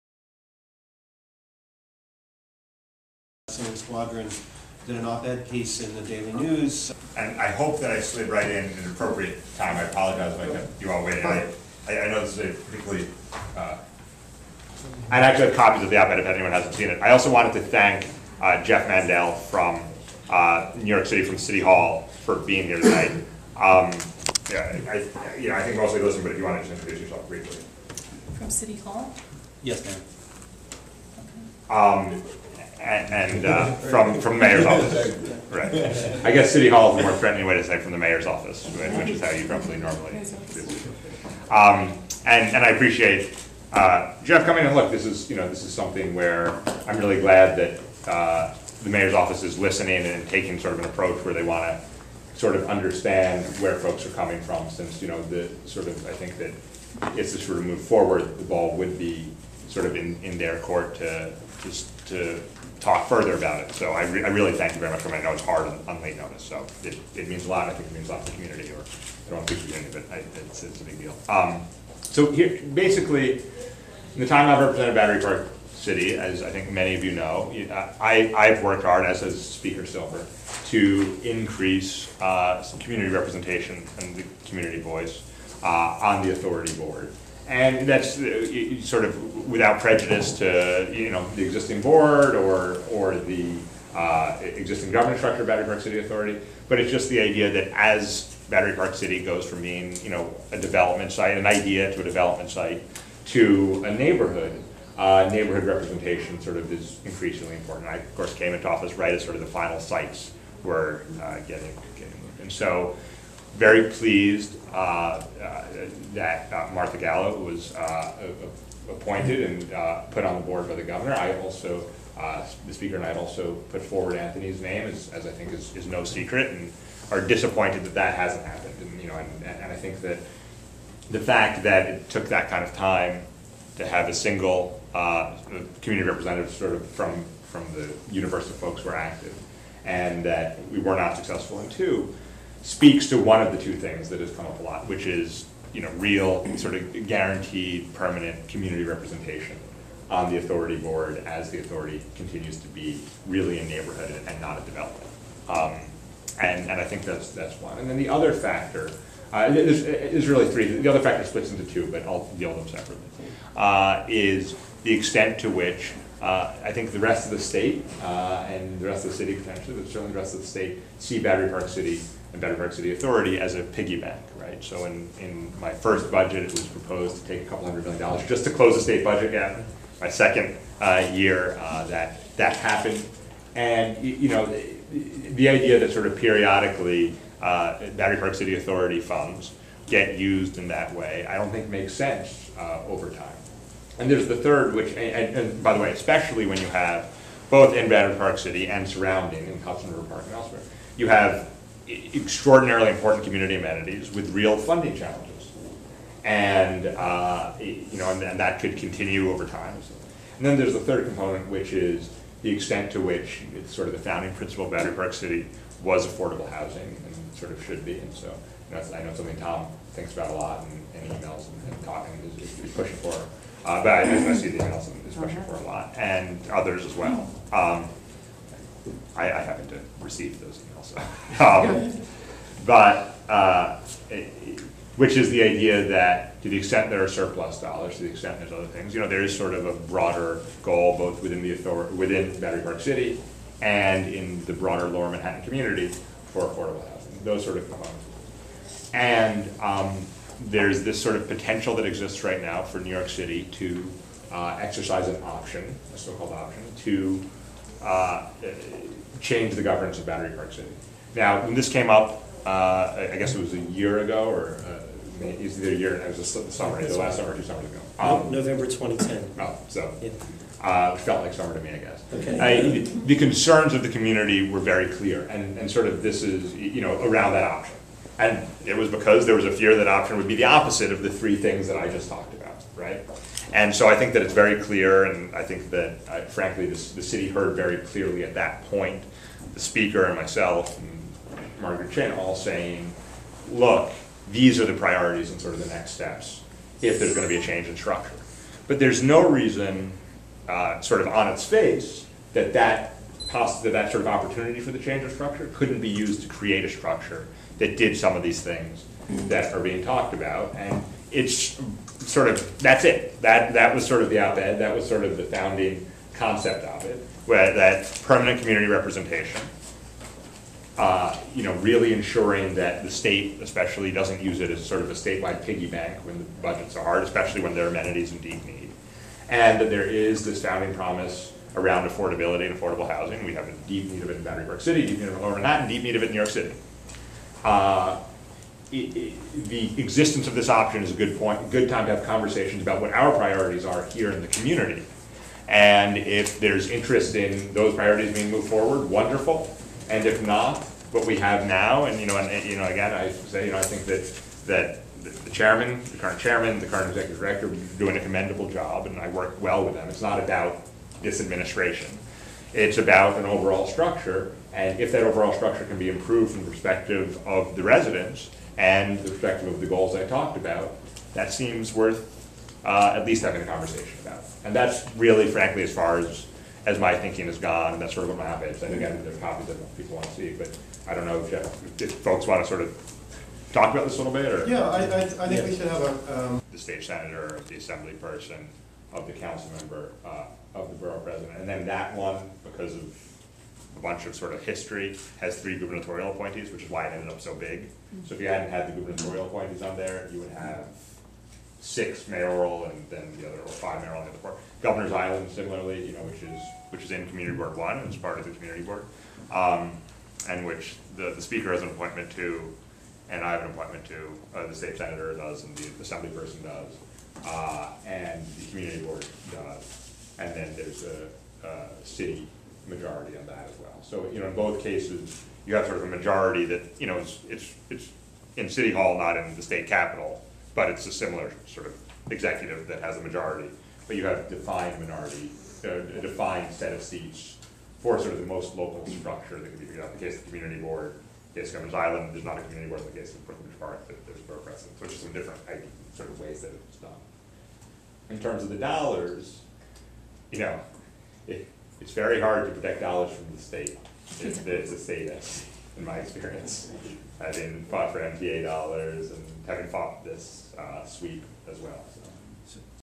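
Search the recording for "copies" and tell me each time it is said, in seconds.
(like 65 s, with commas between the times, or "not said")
15 s, 379 s.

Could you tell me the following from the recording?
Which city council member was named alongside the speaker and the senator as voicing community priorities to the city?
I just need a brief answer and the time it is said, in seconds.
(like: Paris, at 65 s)
Margaret Chin, at 291 s.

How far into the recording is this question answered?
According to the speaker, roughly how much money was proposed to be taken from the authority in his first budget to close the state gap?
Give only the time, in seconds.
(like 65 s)
177 s.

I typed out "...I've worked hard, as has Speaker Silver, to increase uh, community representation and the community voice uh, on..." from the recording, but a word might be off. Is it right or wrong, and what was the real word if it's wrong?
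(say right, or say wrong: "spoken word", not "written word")
right.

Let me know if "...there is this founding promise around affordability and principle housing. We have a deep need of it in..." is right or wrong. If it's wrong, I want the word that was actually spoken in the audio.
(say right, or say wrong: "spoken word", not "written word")
wrong: "affordable", not "principle".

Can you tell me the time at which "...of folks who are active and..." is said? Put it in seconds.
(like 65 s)
138 s.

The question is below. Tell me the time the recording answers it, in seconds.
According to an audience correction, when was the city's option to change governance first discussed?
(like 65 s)
268 s.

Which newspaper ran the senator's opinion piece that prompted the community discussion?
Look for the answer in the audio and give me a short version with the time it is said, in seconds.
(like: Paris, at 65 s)
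Daily News, at 6 s.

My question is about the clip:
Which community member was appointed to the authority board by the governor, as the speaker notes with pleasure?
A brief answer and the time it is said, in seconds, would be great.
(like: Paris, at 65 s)
Martha Gallo, at 116 s.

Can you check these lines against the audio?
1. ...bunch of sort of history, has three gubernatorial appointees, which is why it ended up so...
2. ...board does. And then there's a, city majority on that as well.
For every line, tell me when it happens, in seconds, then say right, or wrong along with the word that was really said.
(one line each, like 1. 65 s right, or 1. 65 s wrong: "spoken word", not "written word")
1. 393 s right
2. 418 s right.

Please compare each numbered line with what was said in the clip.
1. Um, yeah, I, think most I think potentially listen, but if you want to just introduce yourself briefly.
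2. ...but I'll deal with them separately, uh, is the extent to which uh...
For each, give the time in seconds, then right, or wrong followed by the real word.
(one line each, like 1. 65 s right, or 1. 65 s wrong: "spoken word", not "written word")
1. 23 s wrong: "mostly", not "potentially"
2. 161 s right.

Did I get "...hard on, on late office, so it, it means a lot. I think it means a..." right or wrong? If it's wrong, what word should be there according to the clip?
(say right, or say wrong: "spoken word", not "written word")
wrong: "notice", not "office".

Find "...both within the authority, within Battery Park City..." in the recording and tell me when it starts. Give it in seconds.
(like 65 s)
240 s.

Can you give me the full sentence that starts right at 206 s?
And, uh, you know, and, and, that could continue over time.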